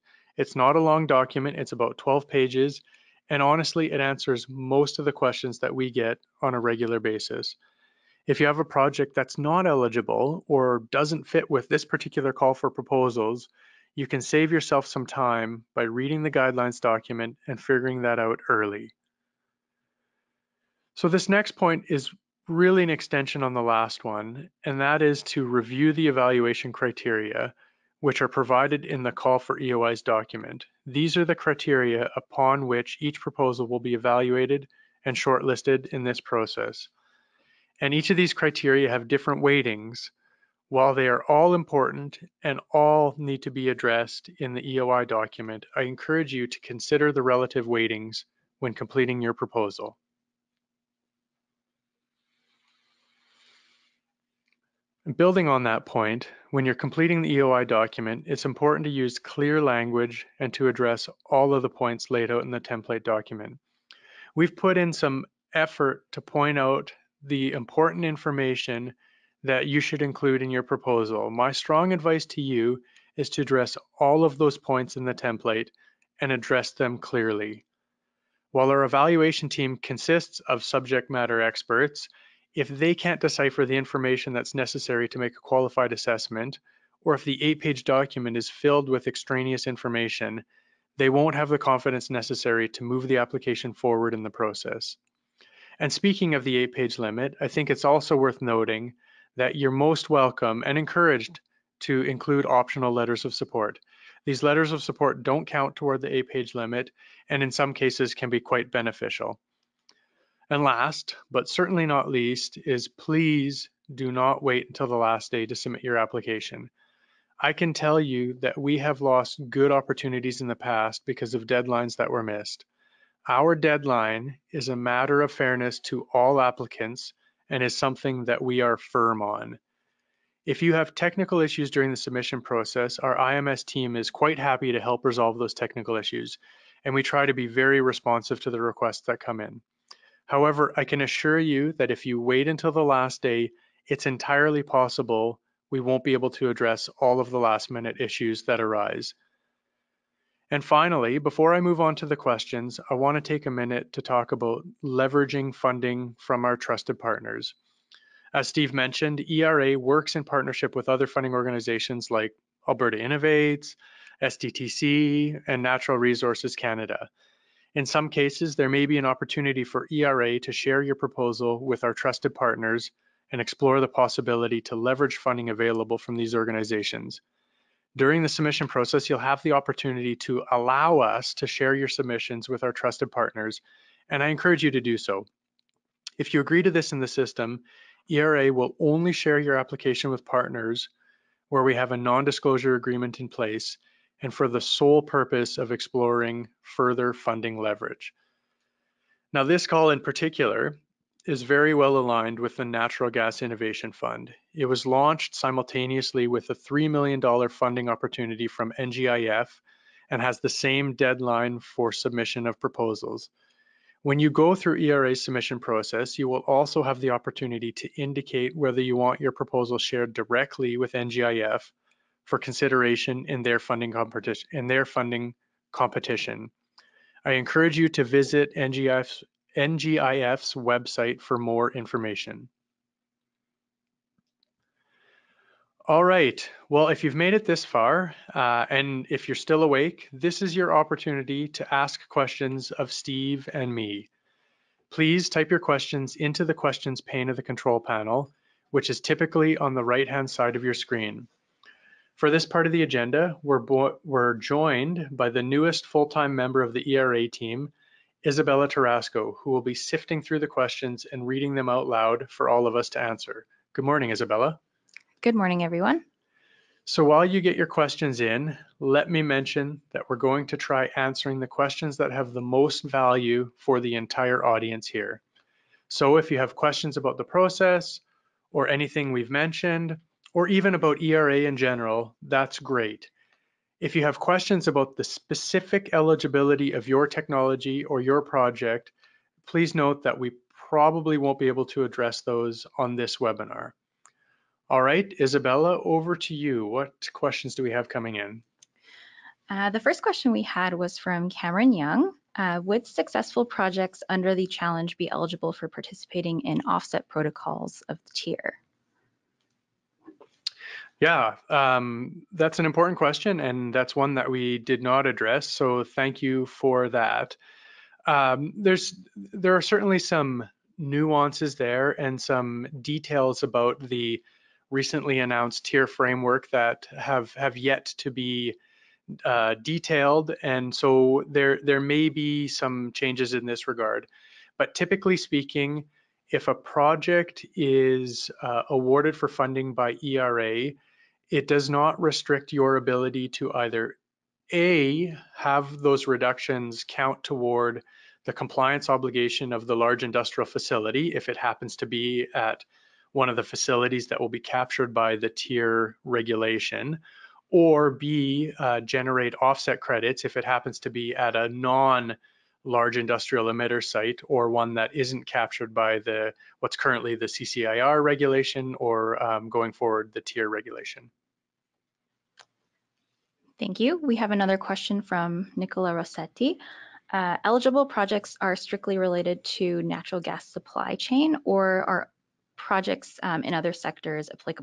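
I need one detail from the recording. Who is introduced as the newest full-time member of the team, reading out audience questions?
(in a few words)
Isabella Tarasco.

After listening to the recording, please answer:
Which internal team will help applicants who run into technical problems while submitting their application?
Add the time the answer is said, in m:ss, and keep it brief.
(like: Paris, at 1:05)
IMS team, at 2:13.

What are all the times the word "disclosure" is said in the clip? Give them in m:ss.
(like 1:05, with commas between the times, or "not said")
3:11.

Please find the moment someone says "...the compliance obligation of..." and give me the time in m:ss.
5:48.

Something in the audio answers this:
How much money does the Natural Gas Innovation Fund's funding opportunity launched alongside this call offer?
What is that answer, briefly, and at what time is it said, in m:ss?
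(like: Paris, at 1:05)
$3 million, at 3:26.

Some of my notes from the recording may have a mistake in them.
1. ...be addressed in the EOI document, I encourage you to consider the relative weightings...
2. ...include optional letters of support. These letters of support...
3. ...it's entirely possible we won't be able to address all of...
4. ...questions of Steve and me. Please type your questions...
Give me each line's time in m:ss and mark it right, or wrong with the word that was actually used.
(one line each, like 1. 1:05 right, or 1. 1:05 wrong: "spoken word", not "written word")
1. 0:43 right
2. 1:42 right
3. 2:23 right
4. 4:02 right.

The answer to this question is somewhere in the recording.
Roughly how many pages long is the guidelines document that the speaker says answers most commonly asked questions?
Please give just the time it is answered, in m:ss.
0:01.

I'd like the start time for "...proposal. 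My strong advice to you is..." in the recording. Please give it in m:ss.
1:10.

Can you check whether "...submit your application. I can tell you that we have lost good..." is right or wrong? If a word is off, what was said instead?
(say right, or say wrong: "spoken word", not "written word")
right.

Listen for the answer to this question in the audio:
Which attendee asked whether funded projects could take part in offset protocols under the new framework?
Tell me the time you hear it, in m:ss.
5:01.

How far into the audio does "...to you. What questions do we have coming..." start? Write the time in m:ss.
4:56.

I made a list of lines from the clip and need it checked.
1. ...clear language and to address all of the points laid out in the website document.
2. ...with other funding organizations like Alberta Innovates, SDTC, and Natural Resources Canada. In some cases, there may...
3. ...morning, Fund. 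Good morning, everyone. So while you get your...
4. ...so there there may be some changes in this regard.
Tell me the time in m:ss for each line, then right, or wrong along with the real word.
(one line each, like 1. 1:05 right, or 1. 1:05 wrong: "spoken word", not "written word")
1. 0:59 wrong: "template", not "website"
2. 2:40 right
3. 4:23 wrong: "Isabella", not "Fund"
4. 5:30 right.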